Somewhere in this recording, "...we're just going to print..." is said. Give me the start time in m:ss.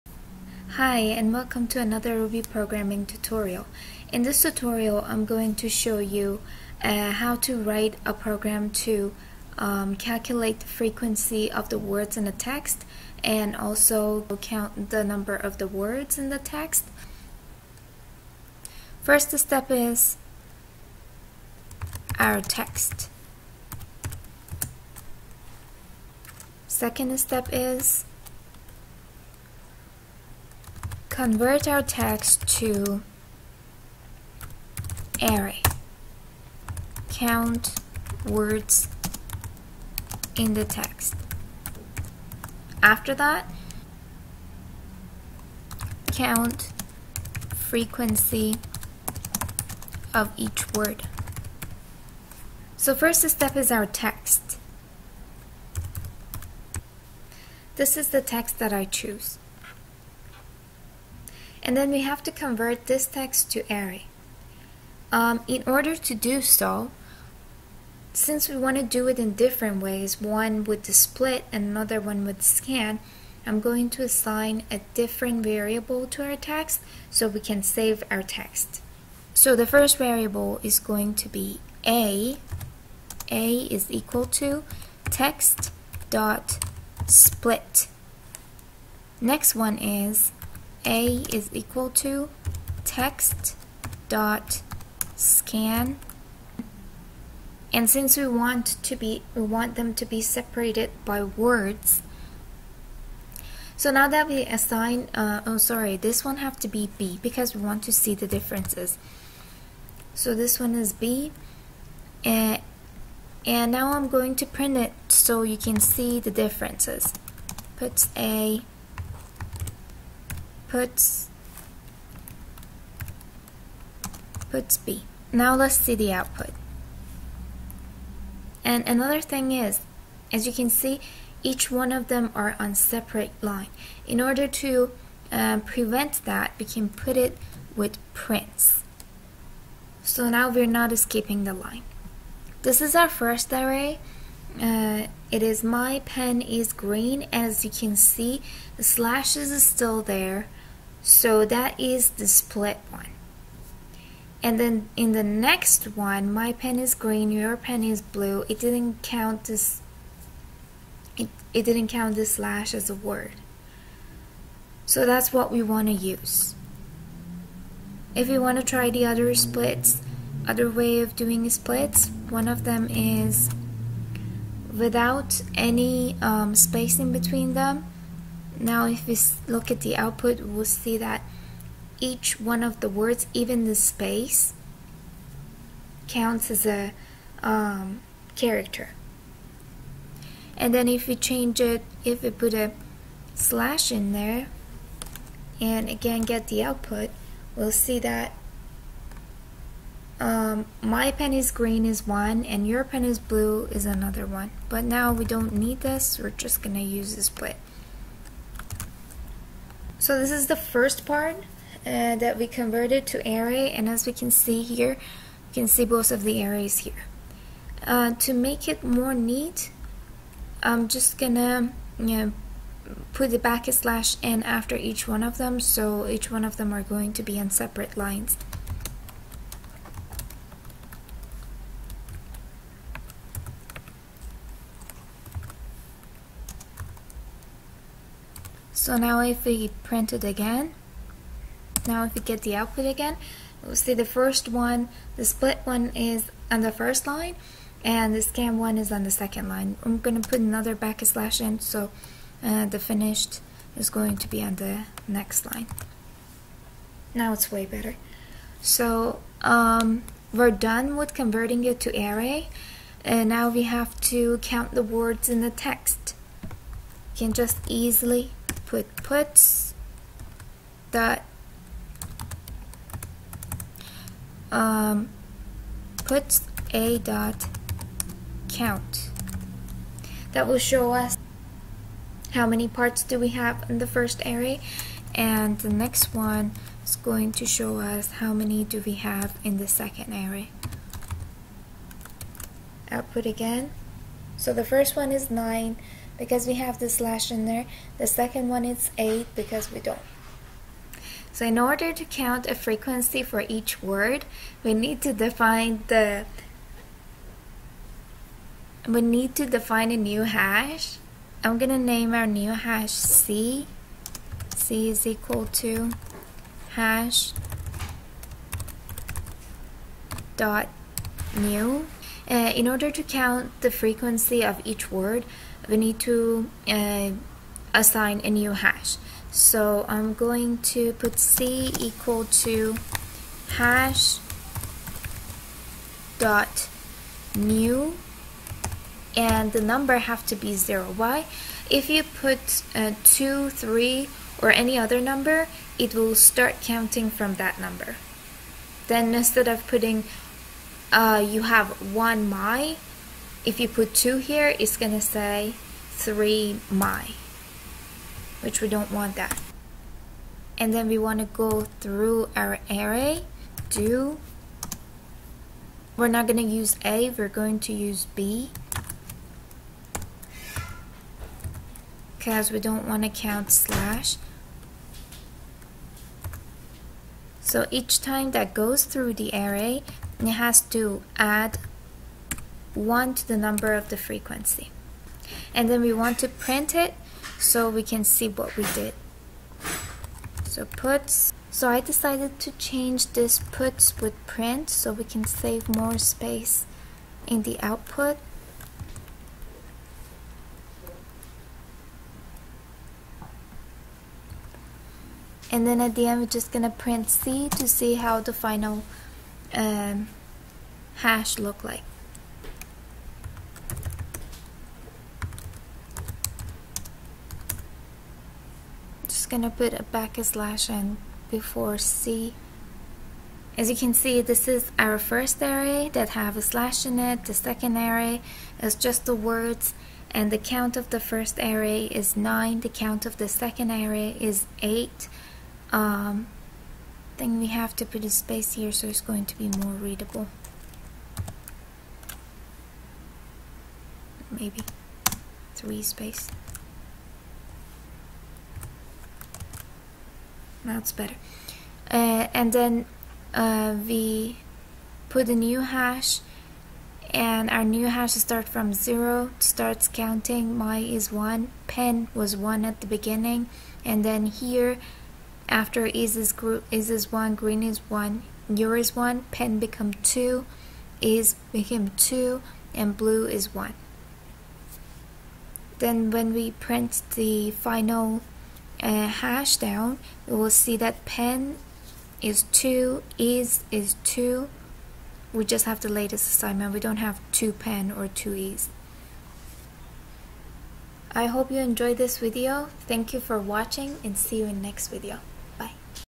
6:46.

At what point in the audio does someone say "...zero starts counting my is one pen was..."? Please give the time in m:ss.
7:38.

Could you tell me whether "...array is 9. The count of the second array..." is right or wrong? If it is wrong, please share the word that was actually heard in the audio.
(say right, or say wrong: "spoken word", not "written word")
right.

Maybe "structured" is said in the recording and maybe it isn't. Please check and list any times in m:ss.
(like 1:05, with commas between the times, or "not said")
not said.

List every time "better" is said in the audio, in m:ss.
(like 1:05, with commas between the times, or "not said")
4:17, 7:30.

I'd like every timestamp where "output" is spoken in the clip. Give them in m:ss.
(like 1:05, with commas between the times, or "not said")
2:06, 2:59, 3:16, 4:02, 4:52, 6:37.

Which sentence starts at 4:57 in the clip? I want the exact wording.
The second one is 8 because we don't.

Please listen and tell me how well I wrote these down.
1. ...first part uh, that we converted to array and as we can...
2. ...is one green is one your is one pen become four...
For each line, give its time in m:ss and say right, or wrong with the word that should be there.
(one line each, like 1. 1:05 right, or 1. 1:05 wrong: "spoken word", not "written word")
1. 3:30 right
2. 7:46 wrong: "two", not "four".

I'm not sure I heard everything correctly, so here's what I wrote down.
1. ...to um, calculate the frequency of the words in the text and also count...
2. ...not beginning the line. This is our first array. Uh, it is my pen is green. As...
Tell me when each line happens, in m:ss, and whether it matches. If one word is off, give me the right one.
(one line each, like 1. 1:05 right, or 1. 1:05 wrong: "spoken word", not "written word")
1. 0:08 right
2. 2:20 wrong: "escaping", not "beginning".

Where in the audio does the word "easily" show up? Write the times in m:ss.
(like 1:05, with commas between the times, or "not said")
4:27.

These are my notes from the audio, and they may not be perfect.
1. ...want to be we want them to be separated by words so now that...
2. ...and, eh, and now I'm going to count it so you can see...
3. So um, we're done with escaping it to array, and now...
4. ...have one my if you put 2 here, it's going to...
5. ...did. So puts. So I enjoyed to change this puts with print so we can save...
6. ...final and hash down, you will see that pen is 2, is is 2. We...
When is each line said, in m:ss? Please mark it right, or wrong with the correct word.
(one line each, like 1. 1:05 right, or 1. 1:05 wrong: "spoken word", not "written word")
1. 1:38 right
2. 1:52 wrong: "print", not "count"
3. 4:18 wrong: "converting", not "escaping"
4. 5:51 right
5. 6:28 wrong: "decided", not "enjoyed"
6. 7:57 right.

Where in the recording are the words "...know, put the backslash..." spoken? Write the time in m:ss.
3:42.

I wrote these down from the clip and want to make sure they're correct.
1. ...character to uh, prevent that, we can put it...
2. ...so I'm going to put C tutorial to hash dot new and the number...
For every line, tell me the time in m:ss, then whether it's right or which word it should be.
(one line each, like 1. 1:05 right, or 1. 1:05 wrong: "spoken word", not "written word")
1. 2:14 wrong: "order", not "character"
2. 5:29 wrong: "equal", not "tutorial".